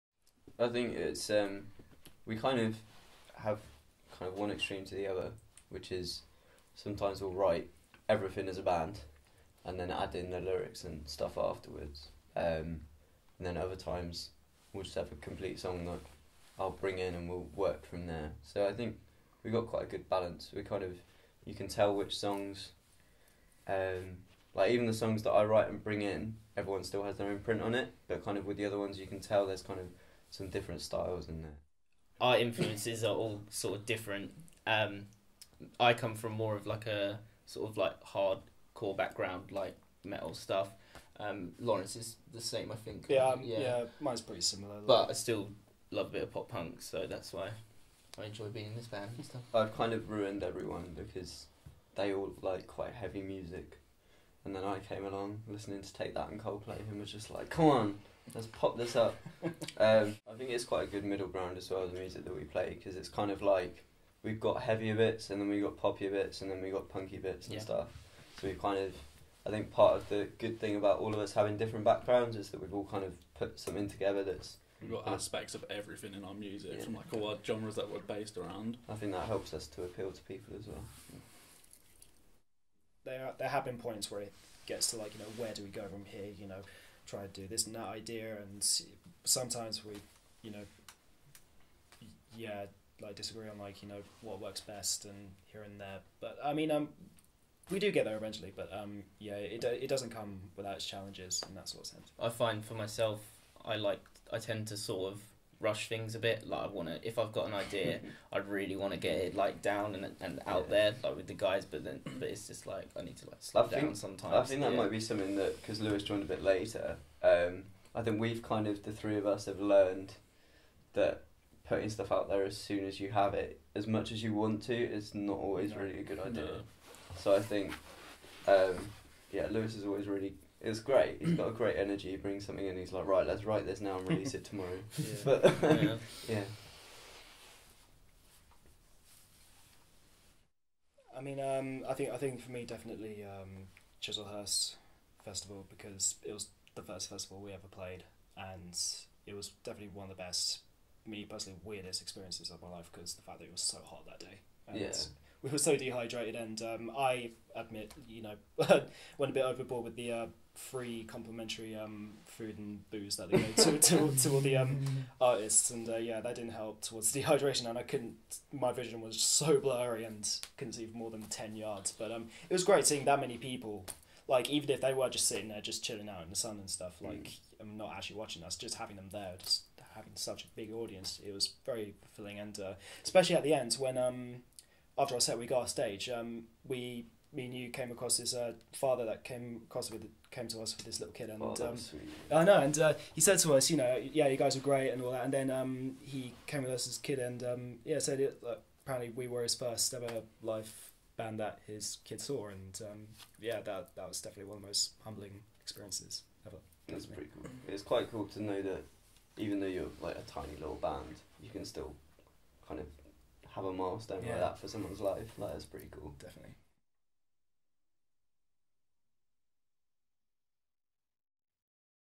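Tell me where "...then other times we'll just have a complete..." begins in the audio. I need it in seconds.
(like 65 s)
13 s.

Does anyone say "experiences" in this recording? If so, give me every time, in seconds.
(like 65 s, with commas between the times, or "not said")
152 s, 205 s.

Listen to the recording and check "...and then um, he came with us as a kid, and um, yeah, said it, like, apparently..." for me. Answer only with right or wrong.
right.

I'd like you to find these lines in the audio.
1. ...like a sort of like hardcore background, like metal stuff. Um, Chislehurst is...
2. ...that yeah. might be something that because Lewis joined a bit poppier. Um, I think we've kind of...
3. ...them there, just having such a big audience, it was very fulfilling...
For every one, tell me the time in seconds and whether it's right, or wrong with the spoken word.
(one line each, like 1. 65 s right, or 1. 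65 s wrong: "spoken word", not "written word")
1. 36 s wrong: "Lawrence", not "Chislehurst"
2. 114 s wrong: "later", not "poppier"
3. 178 s right.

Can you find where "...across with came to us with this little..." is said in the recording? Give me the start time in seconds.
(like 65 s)
189 s.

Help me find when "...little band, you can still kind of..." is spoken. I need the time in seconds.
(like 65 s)
210 s.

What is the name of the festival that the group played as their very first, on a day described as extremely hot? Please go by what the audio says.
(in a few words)
Chislehurst Festival.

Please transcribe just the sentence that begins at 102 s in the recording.
I find for myself, I like I tend to sort of rush things a bit.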